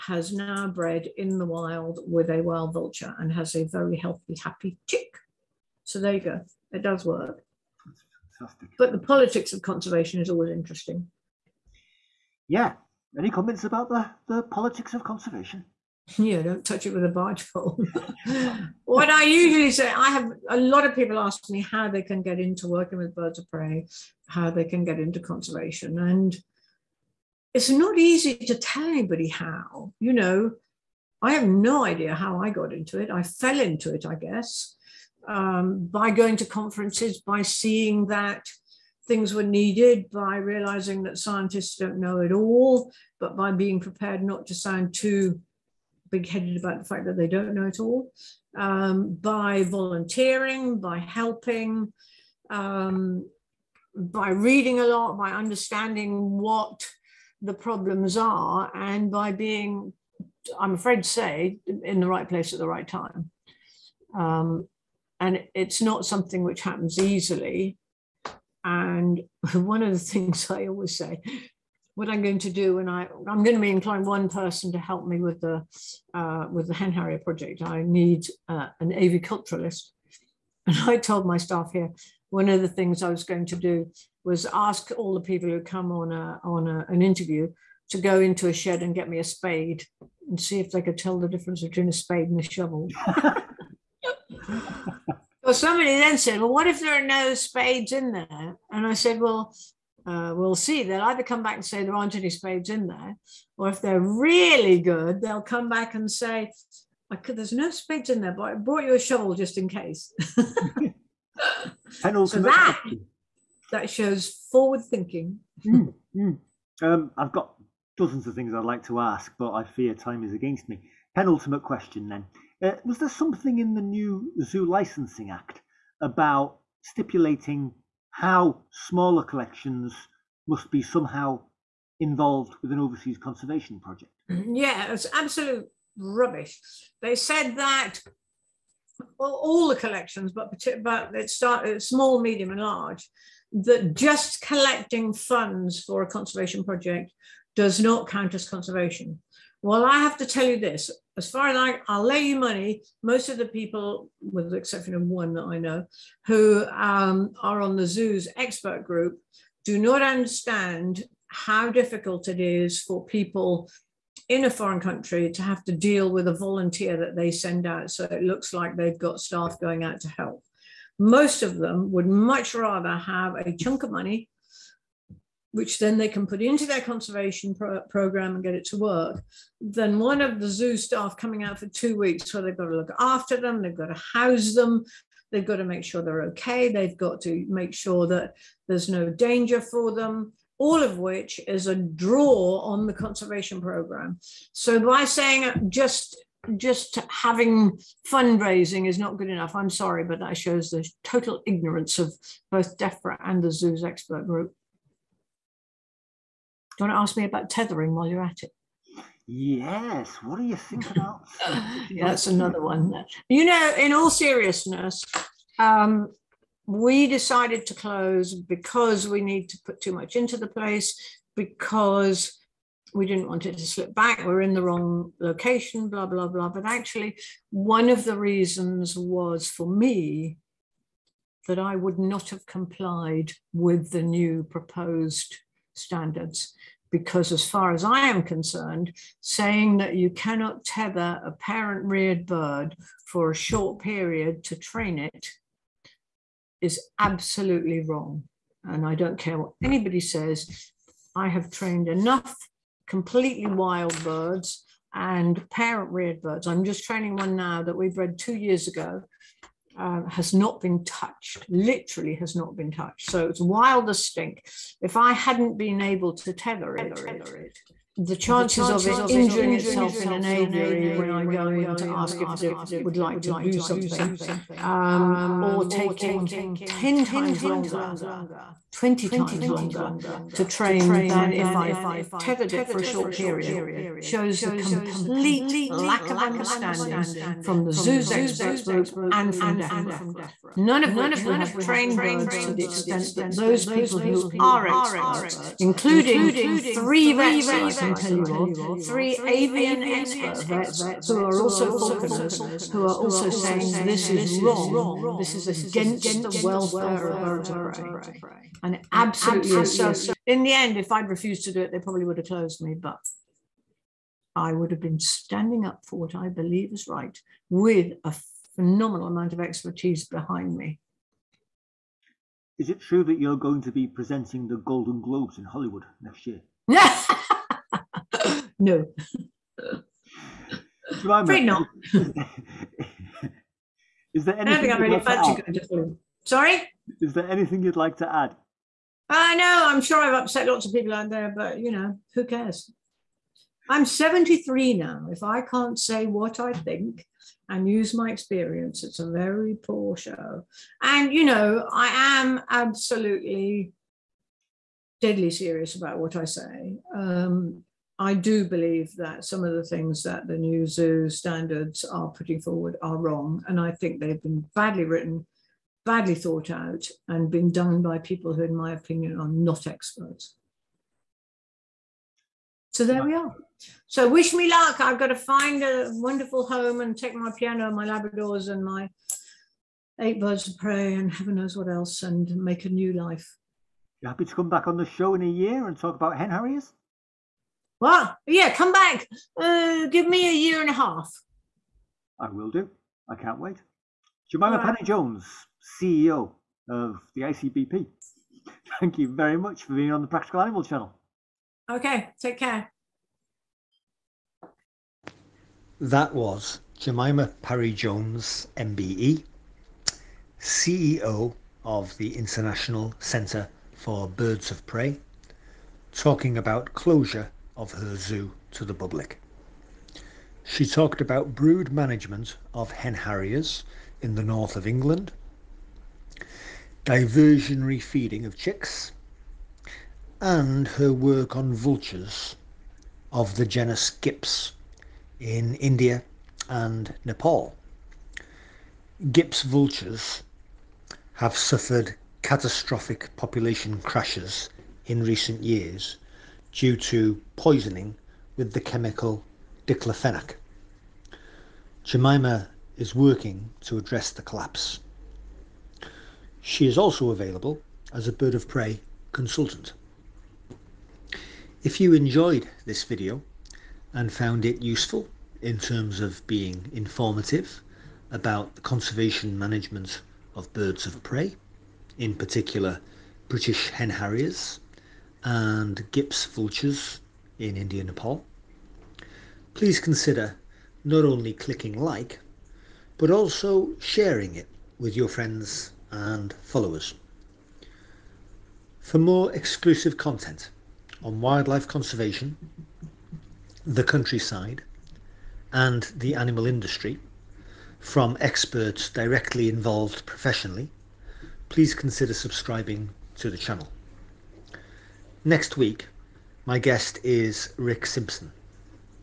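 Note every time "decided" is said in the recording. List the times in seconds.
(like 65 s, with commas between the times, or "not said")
217 s.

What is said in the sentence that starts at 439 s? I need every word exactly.
Gyps vultures have suffered catastrophic population crashes in recent years due to poisoning with the chemical diclofenac.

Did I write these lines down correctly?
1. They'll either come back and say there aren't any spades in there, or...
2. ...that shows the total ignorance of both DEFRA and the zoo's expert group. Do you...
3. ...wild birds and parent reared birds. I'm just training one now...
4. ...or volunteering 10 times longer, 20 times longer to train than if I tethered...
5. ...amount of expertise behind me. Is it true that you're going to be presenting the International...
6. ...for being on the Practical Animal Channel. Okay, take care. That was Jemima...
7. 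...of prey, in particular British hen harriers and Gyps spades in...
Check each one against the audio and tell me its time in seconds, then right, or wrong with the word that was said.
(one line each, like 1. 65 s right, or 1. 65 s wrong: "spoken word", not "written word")
1. 100 s right
2. 200 s right
3. 253 s right
4. 275 s wrong: "taking", not "volunteering"
5. 319 s wrong: "Golden", not "International"
6. 399 s right
7. 470 s wrong: "vultures", not "spades".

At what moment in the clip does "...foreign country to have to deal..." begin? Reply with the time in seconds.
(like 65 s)
164 s.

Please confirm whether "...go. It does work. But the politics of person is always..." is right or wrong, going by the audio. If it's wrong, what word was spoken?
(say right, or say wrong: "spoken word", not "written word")
wrong: "conservation", not "person".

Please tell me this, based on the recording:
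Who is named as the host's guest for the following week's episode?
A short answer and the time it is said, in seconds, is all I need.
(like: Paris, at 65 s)
Rick Simpson, at 507 s.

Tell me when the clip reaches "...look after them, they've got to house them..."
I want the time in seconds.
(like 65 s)
182 s.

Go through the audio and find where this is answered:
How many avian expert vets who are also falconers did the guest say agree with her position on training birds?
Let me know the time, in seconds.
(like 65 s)
298 s.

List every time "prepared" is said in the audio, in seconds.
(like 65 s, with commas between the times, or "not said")
43 s.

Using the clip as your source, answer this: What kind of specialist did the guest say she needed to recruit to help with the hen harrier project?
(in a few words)
aviculturalist.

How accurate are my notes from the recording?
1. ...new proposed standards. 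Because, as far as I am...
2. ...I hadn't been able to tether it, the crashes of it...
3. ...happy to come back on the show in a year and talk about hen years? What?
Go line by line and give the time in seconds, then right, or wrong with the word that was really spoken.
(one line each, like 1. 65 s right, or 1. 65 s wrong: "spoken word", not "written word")
1. 234 s right
2. 264 s wrong: "chances", not "crashes"
3. 384 s wrong: "harriers", not "years".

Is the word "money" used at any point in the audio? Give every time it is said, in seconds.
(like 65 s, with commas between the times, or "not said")
152 s, 173 s.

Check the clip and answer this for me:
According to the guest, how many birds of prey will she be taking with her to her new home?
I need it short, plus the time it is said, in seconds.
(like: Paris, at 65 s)
8, at 378 s.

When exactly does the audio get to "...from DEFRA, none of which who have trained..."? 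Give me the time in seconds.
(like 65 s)
289 s.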